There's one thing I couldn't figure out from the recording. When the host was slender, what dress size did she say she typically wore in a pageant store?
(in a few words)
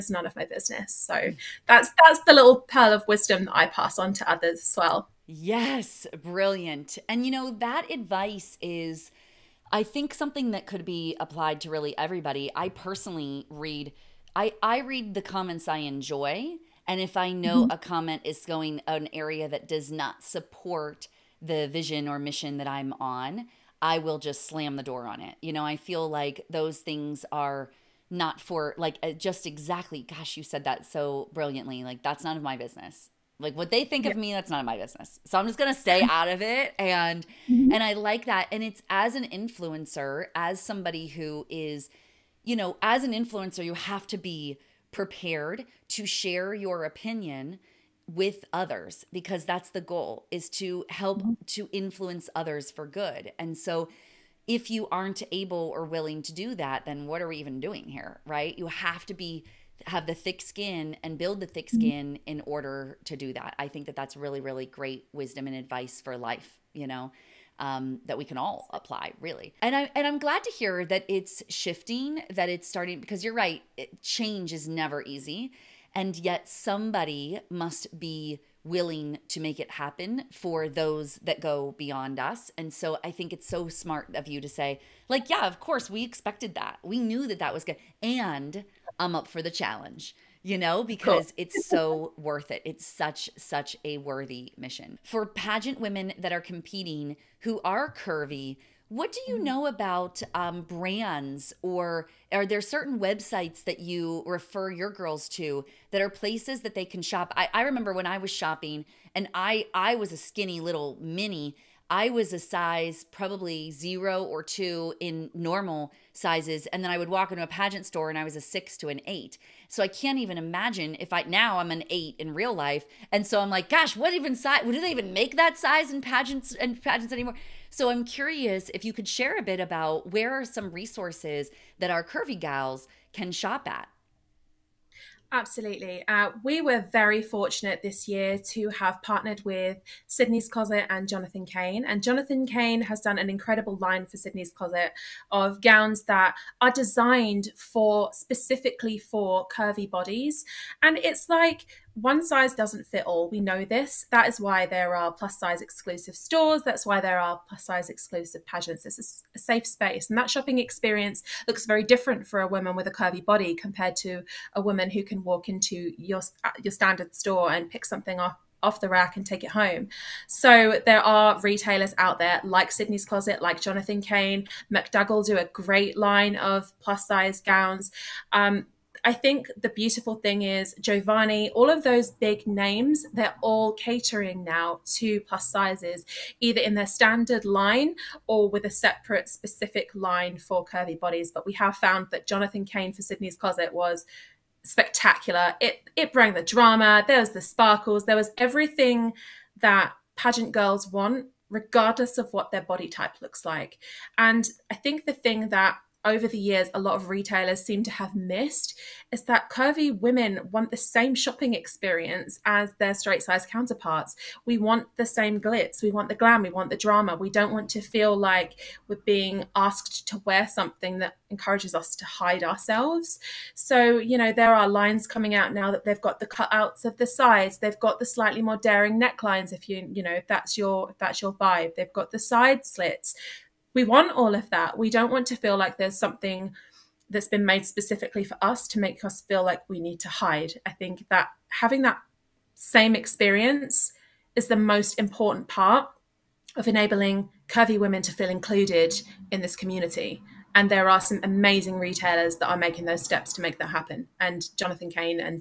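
6 to 8.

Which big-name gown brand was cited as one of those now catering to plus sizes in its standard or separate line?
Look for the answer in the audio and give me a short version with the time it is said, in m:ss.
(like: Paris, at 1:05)
Jovani, at 3:00.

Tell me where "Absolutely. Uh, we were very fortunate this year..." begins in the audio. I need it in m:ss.
2:15.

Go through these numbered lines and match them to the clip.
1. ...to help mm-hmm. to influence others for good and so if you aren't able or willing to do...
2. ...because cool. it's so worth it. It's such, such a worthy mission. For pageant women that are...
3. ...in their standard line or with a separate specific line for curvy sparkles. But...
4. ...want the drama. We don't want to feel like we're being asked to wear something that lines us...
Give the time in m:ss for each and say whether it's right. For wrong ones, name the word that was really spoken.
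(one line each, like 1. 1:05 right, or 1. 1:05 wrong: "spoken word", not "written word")
1. 0:50 right
2. 1:30 right
3. 3:06 wrong: "bodies", not "sparkles"
4. 3:36 wrong: "encourages", not "lines".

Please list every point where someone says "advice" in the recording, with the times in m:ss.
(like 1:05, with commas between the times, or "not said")
0:07, 1:05.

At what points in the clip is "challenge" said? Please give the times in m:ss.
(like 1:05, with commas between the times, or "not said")
1:29.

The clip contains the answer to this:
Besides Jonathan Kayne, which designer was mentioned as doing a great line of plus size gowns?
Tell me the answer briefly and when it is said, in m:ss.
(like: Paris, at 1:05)
McDougall, at 2:54.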